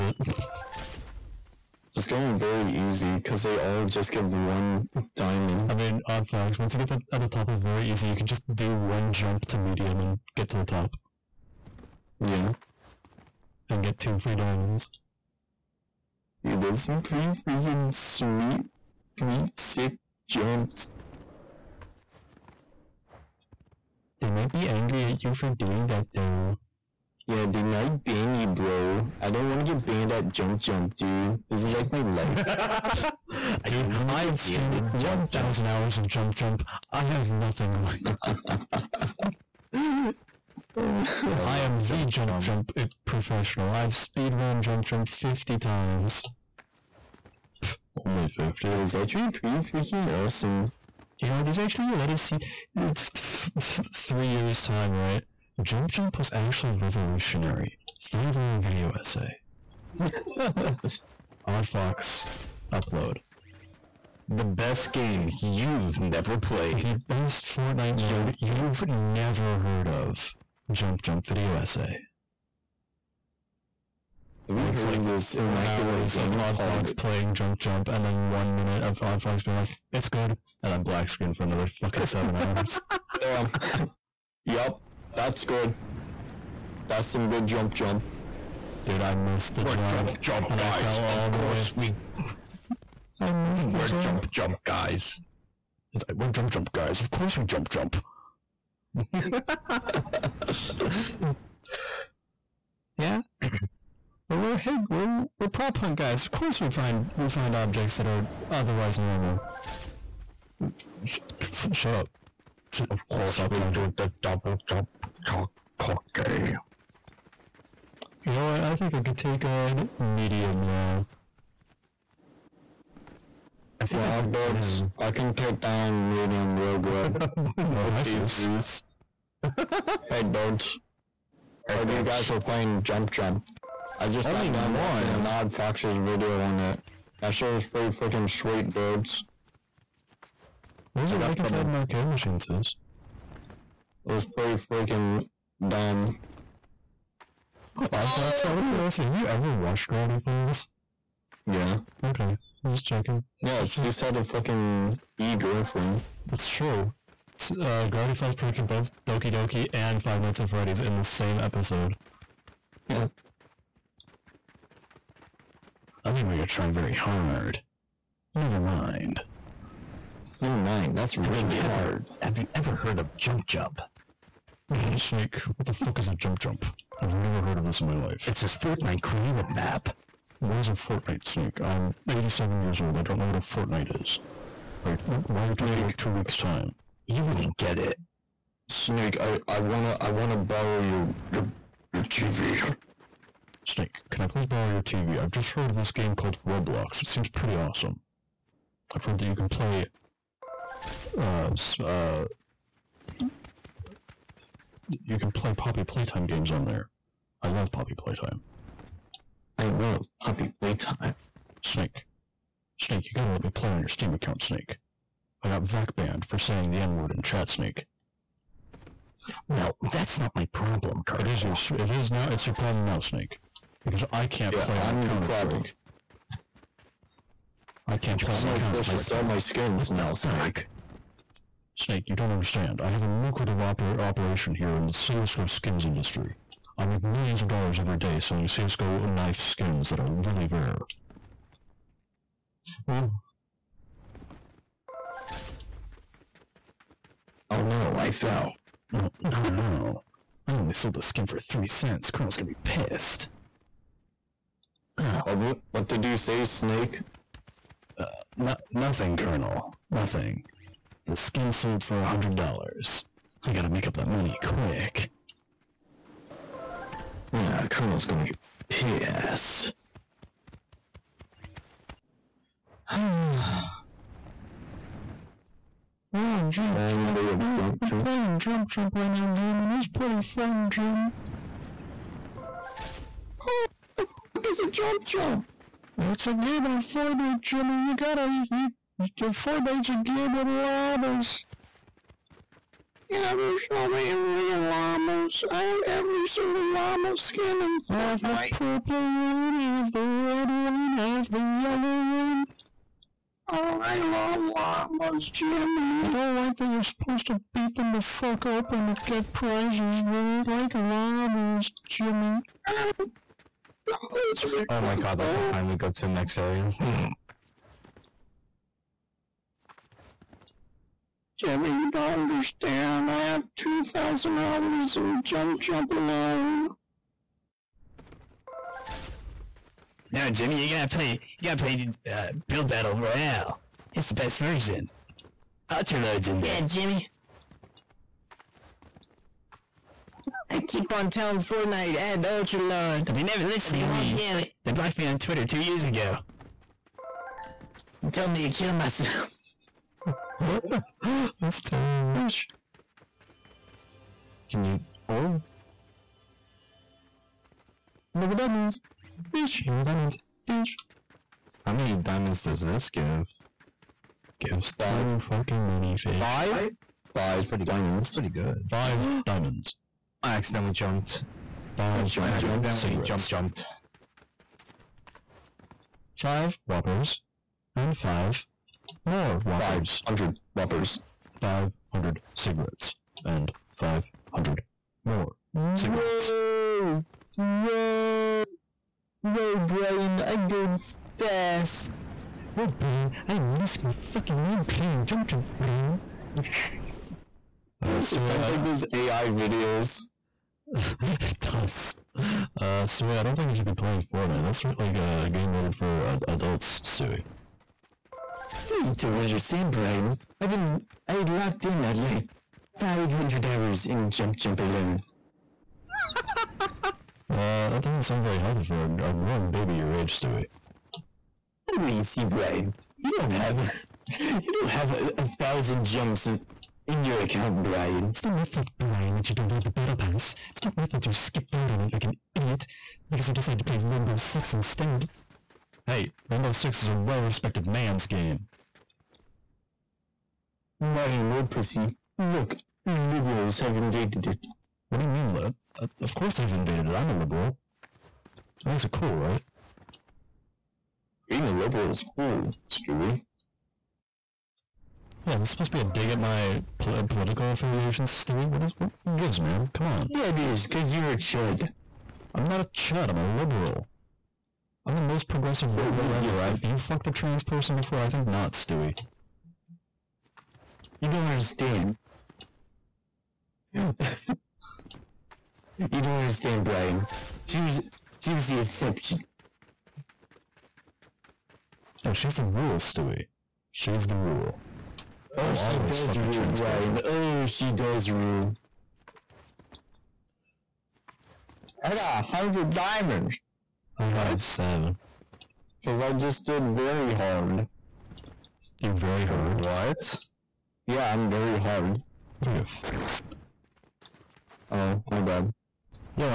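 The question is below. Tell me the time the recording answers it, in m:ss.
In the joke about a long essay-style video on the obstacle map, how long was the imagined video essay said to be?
0:58.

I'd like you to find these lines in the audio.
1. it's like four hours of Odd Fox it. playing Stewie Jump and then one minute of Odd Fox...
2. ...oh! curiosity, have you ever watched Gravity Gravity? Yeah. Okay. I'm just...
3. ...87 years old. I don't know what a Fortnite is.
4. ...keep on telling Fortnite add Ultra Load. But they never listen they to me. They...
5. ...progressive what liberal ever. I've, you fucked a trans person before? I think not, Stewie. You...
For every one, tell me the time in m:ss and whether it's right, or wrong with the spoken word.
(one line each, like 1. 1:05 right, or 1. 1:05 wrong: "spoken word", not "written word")
1. 1:14 wrong: "Jump", not "Stewie"
2. 2:28 wrong: "Falls", not "Gravity"
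3. 3:02 right
4. 5:40 right
5. 7:45 right.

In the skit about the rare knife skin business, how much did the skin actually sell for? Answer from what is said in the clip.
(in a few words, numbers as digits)
3 cents.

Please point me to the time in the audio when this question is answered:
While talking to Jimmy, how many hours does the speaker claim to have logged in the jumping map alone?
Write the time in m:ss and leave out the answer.
5:23.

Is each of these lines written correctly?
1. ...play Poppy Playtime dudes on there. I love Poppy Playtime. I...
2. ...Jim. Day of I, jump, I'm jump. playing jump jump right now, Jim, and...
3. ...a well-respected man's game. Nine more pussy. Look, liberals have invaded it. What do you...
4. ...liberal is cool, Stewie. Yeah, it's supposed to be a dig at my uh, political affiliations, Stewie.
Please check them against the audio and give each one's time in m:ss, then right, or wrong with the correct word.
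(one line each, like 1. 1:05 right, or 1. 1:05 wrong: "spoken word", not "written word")
1. 3:25 wrong: "games", not "dudes"
2. 4:36 right
3. 7:16 right
4. 7:31 right.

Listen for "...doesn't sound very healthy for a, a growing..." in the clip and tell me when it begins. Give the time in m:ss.
6:57.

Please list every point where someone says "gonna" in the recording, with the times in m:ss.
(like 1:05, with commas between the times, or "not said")
4:12, 4:28.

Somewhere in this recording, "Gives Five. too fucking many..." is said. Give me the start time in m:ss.
6:04.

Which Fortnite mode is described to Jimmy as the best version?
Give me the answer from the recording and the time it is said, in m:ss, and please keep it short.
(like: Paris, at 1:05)
Build Battle Royale, at 5:32.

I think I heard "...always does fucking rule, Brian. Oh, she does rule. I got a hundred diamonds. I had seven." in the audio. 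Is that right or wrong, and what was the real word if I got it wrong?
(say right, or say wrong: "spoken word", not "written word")
right.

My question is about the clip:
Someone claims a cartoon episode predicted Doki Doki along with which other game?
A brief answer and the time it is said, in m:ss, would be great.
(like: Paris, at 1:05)
Five Nights at Freddy's, at 2:40.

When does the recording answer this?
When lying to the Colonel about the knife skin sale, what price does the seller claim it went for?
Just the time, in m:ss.
4:22.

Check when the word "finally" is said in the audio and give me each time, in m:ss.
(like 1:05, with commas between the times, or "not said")
5:15.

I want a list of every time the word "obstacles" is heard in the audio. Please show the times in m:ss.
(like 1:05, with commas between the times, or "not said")
not said.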